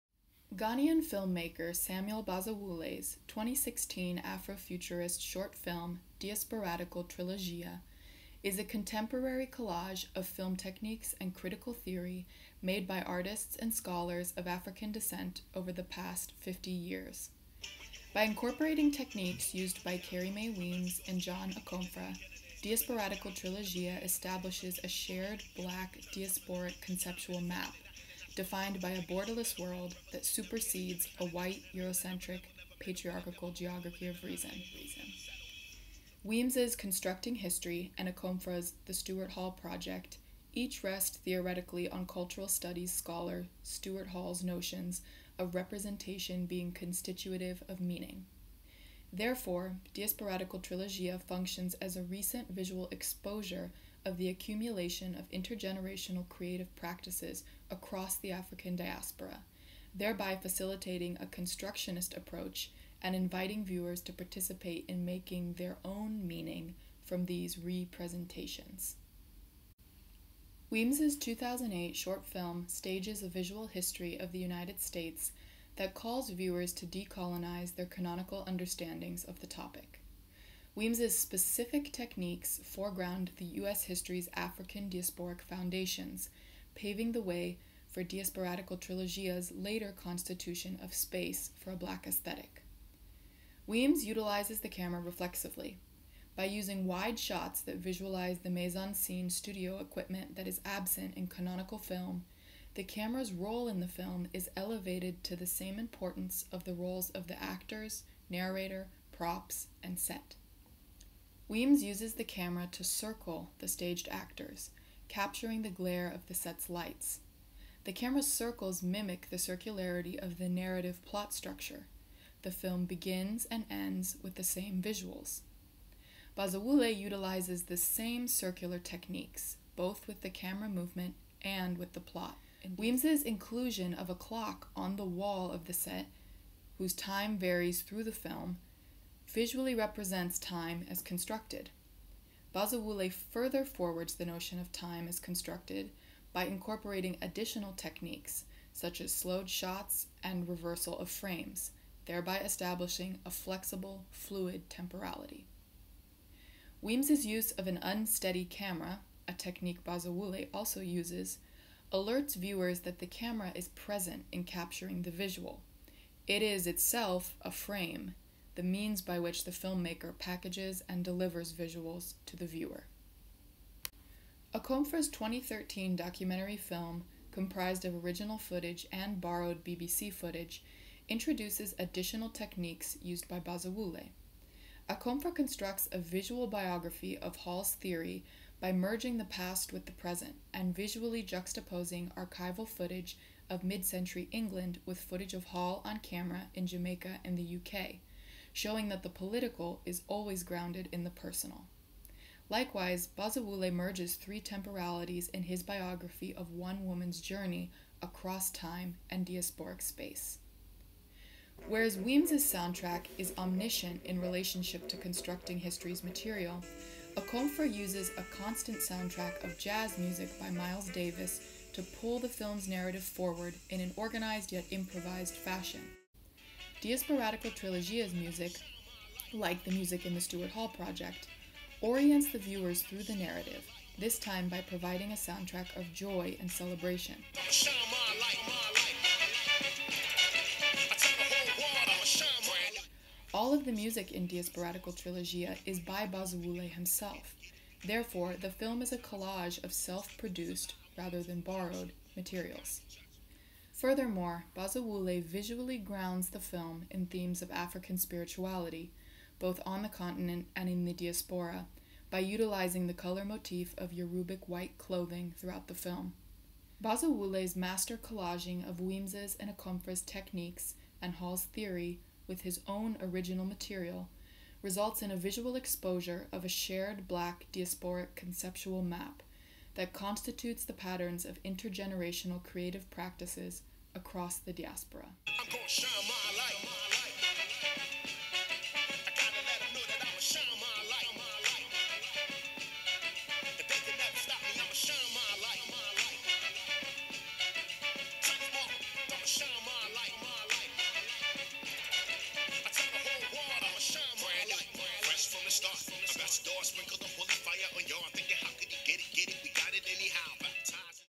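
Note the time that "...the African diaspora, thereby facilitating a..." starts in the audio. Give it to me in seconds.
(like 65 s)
58 s.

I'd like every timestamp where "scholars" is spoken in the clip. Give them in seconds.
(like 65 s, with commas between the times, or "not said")
13 s, 42 s.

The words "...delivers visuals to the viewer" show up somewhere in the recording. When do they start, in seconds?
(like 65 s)
171 s.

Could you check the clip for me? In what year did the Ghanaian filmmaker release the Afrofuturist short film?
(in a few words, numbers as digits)
2016.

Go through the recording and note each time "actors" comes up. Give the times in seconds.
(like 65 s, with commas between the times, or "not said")
107 s, 114 s.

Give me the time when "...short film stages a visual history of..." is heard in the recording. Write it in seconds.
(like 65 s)
71 s.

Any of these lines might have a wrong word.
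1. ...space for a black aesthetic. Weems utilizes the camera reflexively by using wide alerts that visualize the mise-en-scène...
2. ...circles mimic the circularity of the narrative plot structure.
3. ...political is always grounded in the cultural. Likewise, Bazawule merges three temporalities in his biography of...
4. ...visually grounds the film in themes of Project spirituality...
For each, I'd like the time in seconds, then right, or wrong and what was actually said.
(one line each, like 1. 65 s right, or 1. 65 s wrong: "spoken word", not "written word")
1. 90 s wrong: "shots", not "alerts"
2. 118 s right
3. 199 s wrong: "personal", not "cultural"
4. 255 s wrong: "African", not "Project".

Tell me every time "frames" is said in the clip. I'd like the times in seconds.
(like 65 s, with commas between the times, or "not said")
151 s, 167 s.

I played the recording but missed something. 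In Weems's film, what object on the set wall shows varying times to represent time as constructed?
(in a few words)
A clock.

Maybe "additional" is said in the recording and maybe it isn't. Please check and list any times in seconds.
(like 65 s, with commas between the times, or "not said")
147 s, 181 s.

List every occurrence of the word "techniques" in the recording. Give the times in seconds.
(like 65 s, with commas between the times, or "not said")
10 s, 18 s, 81 s, 128 s, 147 s, 159 s, 182 s, 270 s.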